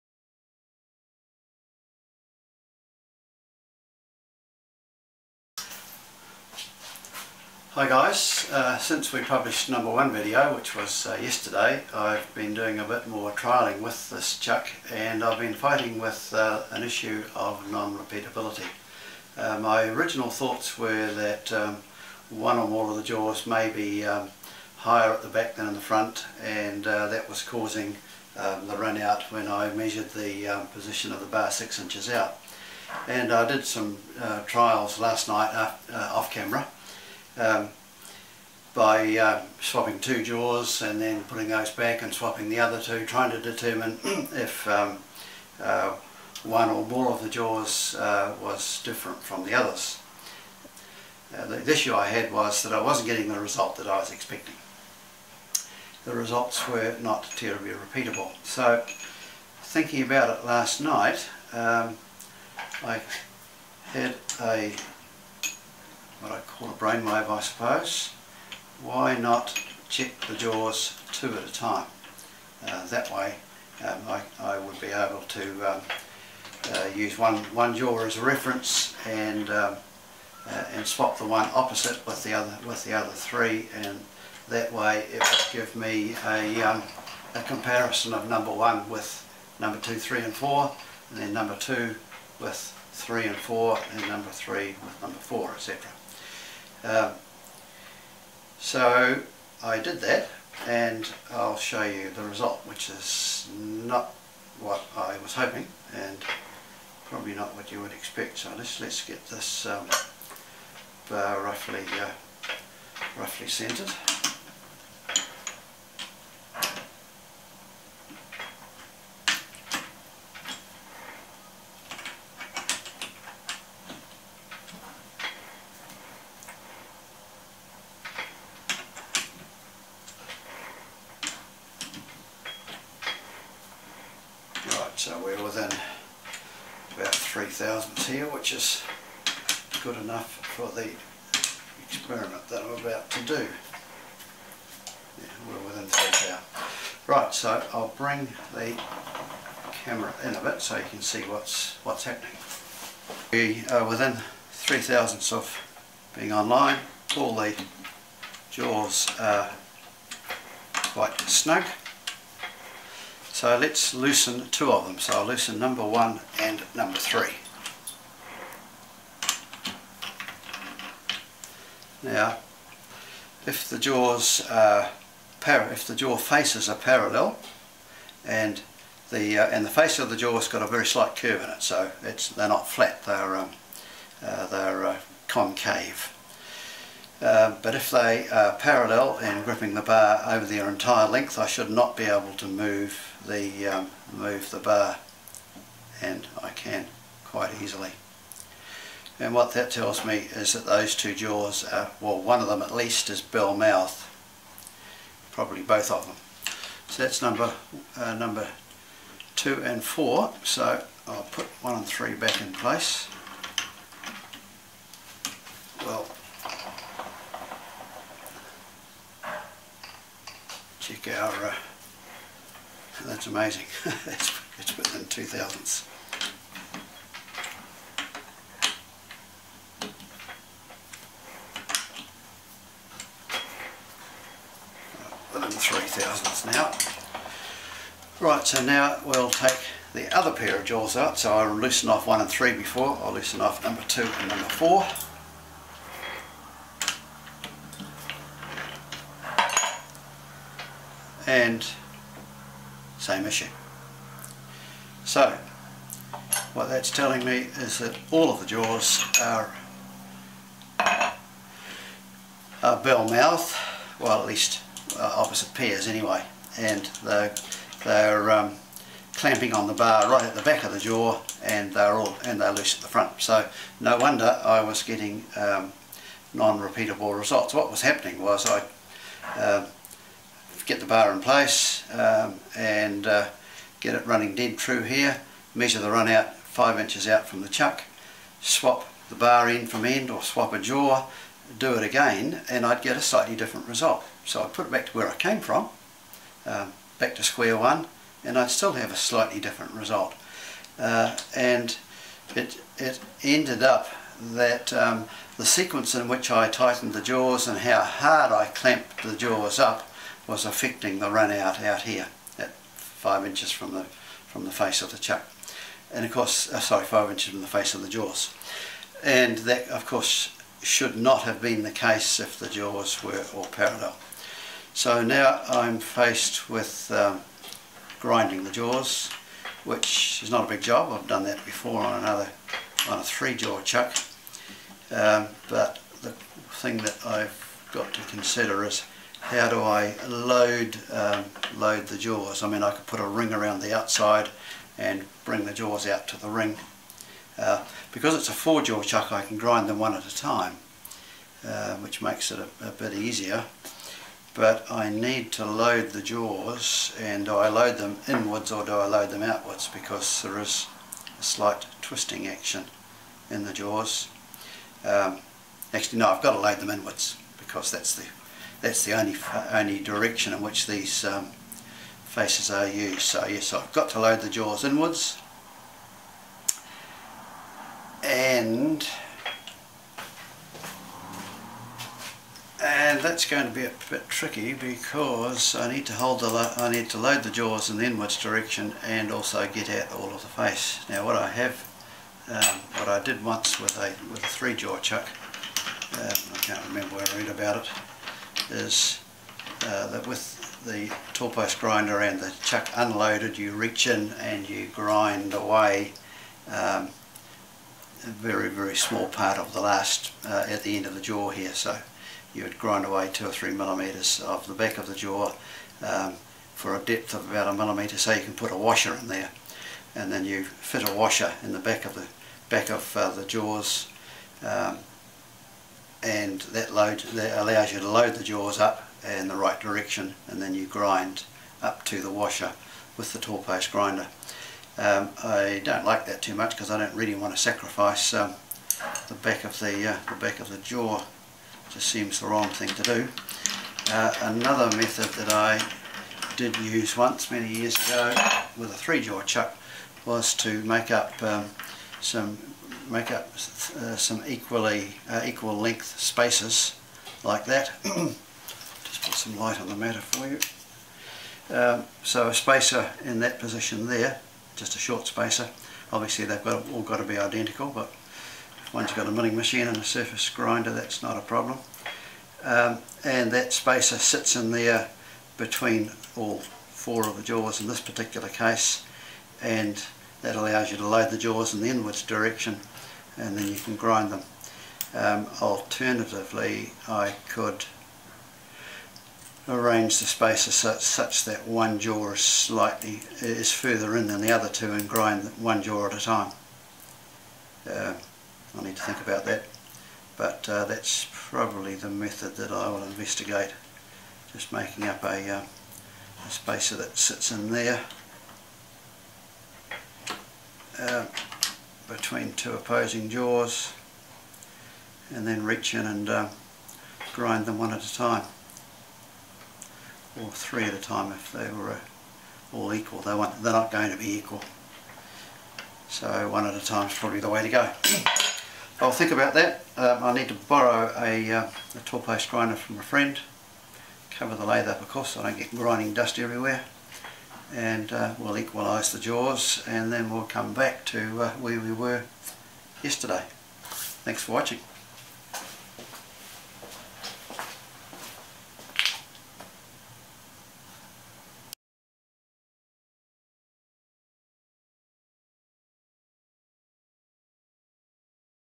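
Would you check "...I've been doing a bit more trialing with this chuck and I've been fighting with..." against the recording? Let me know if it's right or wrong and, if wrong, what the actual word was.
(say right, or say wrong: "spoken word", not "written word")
right.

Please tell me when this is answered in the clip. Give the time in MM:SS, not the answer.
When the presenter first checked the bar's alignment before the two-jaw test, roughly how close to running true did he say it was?
02:15.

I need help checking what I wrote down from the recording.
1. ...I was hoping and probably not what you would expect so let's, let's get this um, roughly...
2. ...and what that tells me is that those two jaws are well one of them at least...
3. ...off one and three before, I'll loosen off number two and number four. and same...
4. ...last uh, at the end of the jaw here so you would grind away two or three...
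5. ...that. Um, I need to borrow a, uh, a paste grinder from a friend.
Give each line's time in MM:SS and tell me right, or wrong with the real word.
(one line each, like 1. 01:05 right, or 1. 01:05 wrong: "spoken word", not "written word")
1. 01:44 right
2. 03:19 right
3. 04:01 right
4. 06:49 right
5. 08:49 right.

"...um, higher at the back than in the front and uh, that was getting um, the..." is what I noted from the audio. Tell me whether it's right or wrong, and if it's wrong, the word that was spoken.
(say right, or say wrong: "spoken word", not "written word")
wrong: "causing", not "getting".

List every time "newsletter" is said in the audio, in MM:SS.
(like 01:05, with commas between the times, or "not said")
not said.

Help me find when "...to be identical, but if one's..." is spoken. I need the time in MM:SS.
07:46.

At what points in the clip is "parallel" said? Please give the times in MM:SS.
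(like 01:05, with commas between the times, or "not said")
02:56, 03:08, 05:23.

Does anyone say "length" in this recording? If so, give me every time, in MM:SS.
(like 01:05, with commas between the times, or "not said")
03:11, 07:35.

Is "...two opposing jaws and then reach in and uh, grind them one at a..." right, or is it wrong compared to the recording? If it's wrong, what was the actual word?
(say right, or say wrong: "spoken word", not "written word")
right.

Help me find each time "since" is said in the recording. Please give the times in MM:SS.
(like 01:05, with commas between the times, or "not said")
00:08.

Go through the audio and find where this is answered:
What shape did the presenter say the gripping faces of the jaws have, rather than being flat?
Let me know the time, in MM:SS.
03:05.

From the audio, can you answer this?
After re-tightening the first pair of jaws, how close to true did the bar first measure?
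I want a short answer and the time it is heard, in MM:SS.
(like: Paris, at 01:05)
2 thousandths, at 03:44.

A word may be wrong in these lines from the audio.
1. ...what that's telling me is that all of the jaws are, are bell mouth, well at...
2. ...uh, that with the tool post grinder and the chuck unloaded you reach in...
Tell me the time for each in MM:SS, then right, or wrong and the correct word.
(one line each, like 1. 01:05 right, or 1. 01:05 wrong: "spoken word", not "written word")
1. 04:16 right
2. 06:39 right.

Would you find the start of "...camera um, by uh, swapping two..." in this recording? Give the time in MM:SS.
00:36.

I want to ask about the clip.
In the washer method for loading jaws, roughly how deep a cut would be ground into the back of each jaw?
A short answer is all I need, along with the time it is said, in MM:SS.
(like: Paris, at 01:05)
About 1 millimeter, at 06:57.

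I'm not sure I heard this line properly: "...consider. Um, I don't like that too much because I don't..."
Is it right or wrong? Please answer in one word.
wrong.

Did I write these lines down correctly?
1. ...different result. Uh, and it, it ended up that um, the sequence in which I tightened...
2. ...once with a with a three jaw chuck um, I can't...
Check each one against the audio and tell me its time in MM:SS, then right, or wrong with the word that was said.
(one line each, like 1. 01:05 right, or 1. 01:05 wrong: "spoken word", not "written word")
1. 04:59 right
2. 06:33 right.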